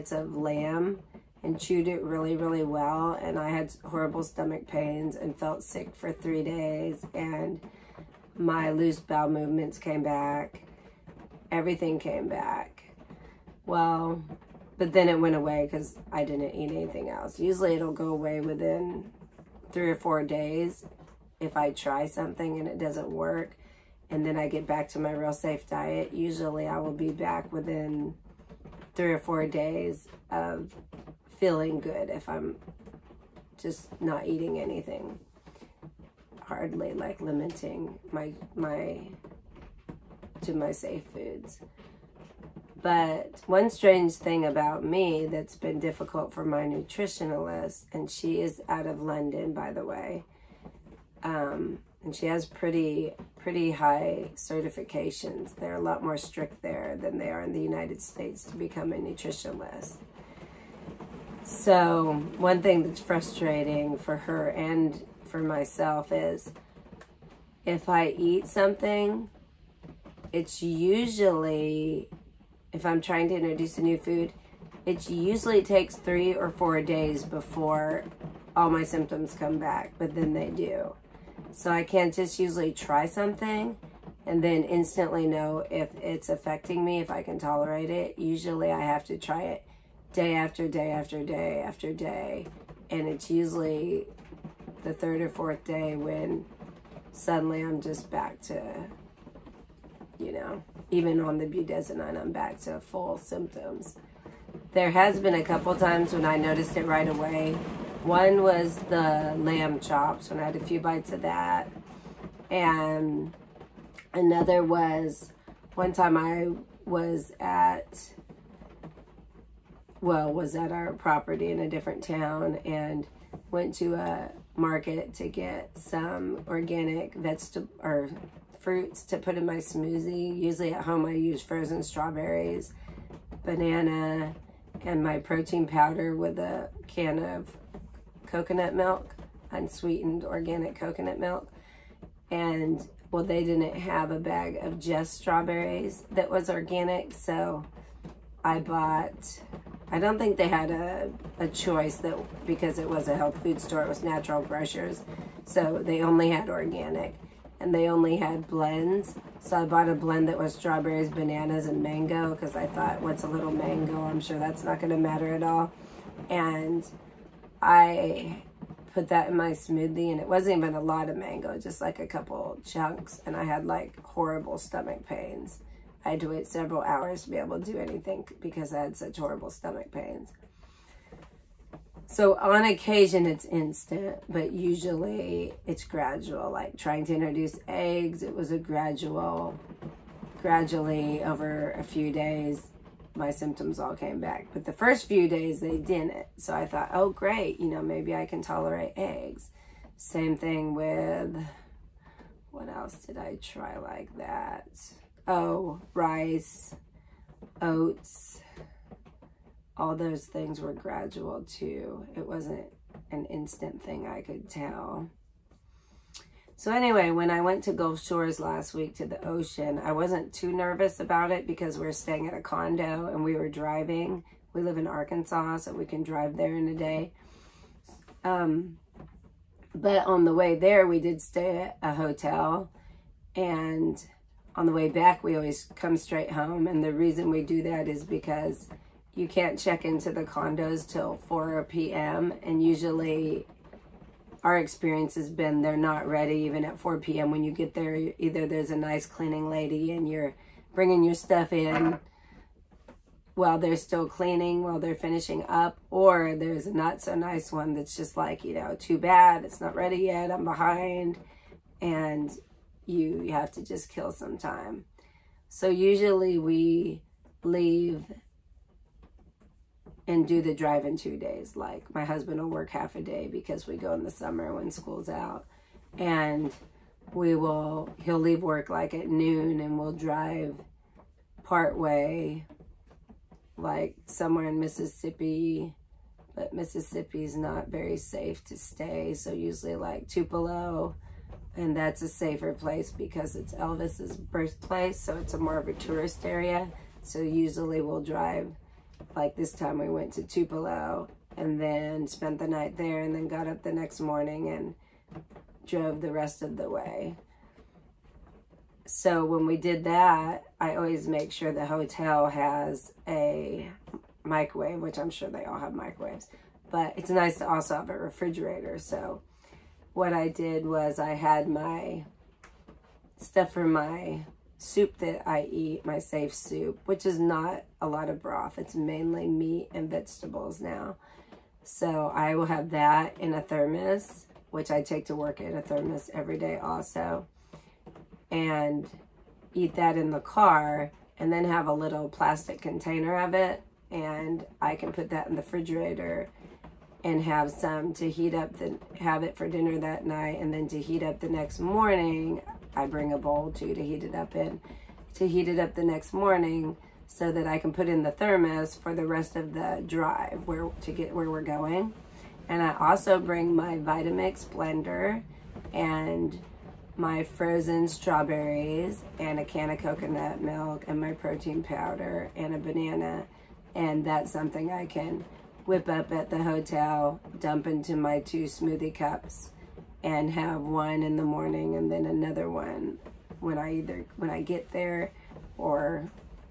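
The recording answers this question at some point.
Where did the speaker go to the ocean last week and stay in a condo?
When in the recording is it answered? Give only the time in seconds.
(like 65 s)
217 s.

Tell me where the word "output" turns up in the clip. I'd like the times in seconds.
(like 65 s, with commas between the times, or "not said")
not said.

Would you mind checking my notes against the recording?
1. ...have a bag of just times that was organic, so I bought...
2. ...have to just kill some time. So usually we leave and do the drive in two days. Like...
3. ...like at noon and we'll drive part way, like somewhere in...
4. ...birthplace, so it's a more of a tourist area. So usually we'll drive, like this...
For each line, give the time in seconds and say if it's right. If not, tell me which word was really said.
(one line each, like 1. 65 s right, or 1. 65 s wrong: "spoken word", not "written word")
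1. 143 s wrong: "strawberries", not "times"
2. 263 s right
3. 278 s right
4. 294 s right.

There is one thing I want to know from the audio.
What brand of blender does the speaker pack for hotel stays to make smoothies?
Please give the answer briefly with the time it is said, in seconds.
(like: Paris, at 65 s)
Vitamix, at 363 s.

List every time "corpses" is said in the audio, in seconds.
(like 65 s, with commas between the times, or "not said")
not said.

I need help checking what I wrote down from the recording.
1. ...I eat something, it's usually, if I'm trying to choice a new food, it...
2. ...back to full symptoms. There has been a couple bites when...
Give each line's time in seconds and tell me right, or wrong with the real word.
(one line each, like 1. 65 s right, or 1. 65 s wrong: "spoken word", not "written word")
1. 67 s wrong: "introduce", not "choice"
2. 102 s wrong: "times", not "bites".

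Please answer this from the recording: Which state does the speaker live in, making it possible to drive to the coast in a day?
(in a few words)
Arkansas.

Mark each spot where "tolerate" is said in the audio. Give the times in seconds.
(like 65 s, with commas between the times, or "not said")
87 s, 198 s.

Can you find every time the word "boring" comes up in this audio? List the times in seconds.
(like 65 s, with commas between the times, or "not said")
not said.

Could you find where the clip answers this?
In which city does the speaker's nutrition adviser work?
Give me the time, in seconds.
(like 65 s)
49 s.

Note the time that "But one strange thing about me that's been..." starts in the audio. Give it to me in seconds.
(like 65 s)
42 s.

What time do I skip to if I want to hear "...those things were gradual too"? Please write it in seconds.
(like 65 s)
209 s.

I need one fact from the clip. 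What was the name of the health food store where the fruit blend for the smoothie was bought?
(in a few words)
Natural Grocers.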